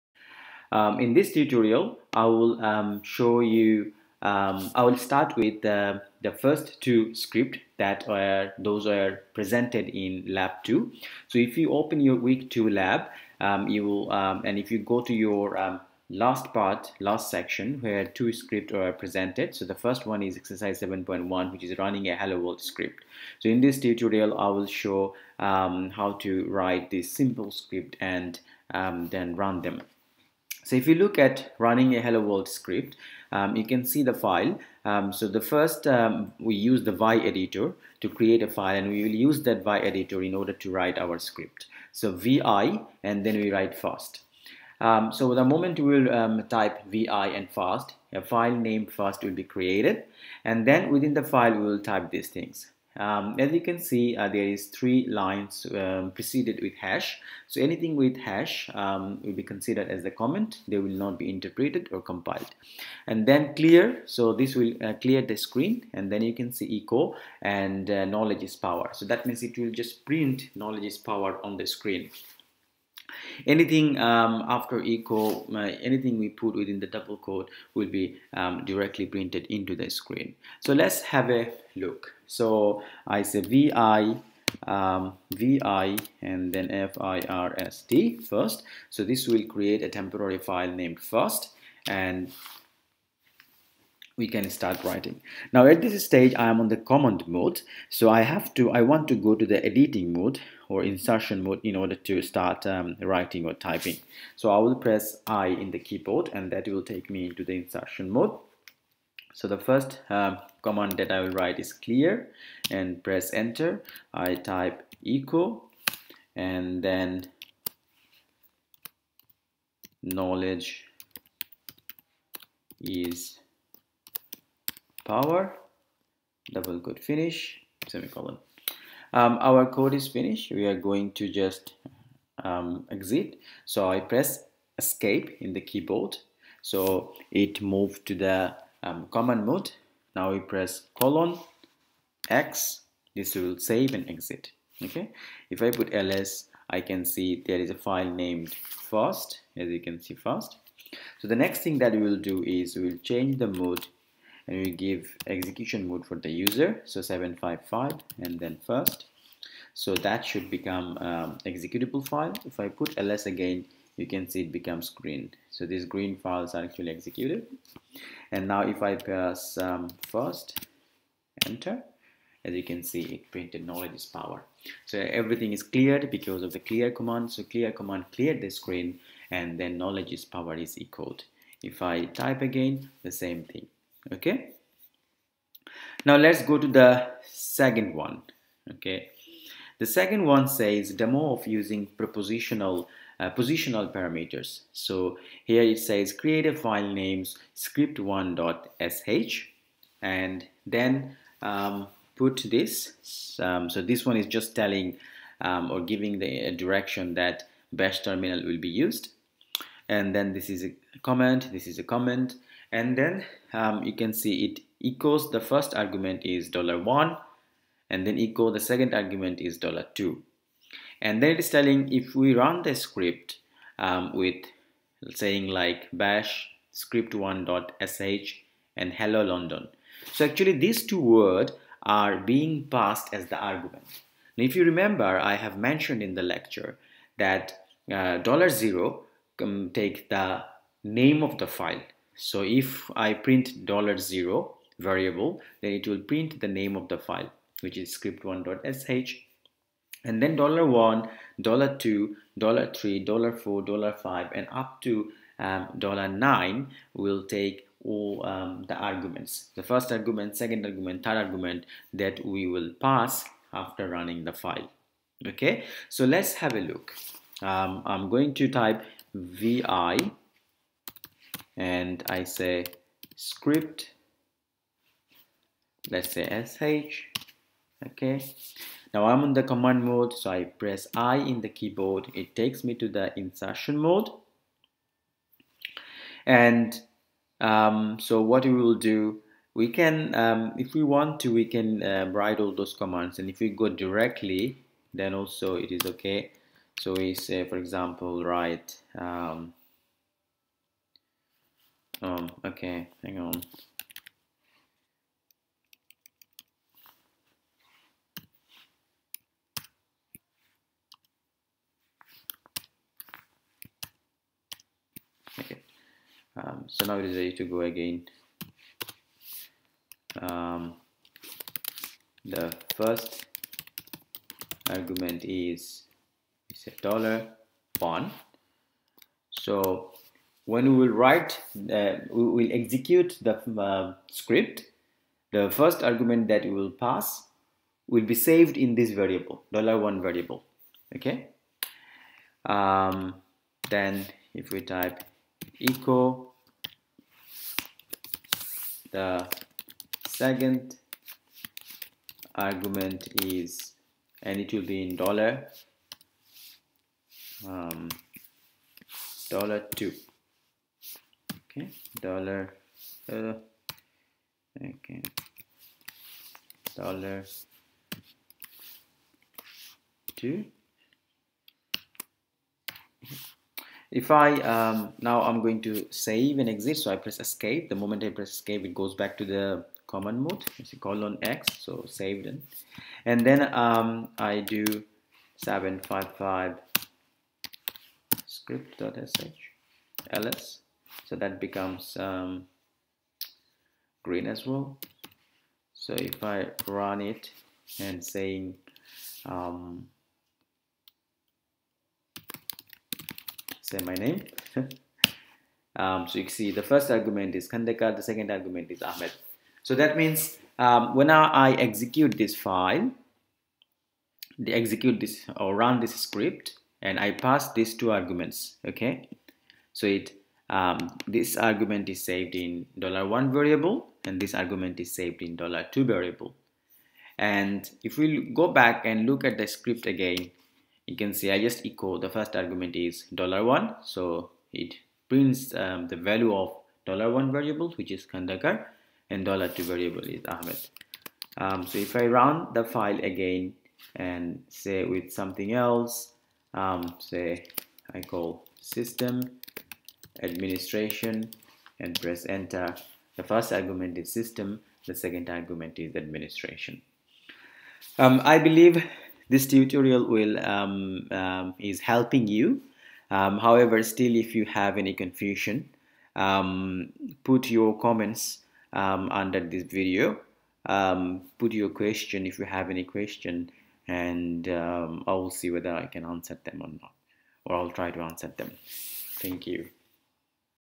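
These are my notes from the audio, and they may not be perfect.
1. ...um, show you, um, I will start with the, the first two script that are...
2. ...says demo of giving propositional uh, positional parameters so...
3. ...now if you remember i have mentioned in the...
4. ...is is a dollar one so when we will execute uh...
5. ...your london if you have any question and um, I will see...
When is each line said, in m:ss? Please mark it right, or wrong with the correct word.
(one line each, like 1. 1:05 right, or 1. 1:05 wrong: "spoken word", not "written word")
1. 0:02 right
2. 3:10 wrong: "using", not "giving"
3. 3:54 right
4. 5:25 wrong: "write", not "execute"
5. 7:51 wrong: "question", not "london".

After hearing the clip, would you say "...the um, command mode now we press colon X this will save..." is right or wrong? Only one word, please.
right.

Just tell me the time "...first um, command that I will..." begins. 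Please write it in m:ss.
1:49.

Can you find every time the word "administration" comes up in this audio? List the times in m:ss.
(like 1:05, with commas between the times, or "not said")
7:30, 7:35.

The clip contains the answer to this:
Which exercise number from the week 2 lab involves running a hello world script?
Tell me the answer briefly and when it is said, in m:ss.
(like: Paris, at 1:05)
7.1, at 0:20.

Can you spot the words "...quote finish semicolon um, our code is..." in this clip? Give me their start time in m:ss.
2:06.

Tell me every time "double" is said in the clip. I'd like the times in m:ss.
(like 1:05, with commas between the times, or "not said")
1:16, 2:06.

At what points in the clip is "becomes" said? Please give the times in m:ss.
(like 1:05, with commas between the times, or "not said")
2:40, 2:44, 6:31.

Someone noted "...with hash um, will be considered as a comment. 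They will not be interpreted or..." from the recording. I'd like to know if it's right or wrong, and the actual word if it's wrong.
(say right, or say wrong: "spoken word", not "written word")
right.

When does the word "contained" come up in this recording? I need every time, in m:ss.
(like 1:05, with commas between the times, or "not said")
not said.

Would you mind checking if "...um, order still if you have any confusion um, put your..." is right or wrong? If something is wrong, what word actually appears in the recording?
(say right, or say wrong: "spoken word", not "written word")
wrong: "however", not "order".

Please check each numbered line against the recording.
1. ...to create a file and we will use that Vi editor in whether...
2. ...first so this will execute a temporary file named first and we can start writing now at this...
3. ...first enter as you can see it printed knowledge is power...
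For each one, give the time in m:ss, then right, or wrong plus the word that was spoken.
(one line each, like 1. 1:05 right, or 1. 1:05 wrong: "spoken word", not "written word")
1. 0:38 wrong: "order", not "whether"
2. 1:28 wrong: "create", not "execute"
3. 2:50 right.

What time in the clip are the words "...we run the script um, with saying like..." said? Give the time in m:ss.
3:42.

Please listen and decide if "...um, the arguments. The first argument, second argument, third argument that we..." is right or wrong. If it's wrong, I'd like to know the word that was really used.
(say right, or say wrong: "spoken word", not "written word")
right.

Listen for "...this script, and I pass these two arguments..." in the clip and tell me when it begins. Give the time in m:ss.
6:55.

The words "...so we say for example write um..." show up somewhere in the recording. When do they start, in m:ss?
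4:56.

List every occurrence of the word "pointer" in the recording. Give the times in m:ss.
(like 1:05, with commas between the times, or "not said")
not said.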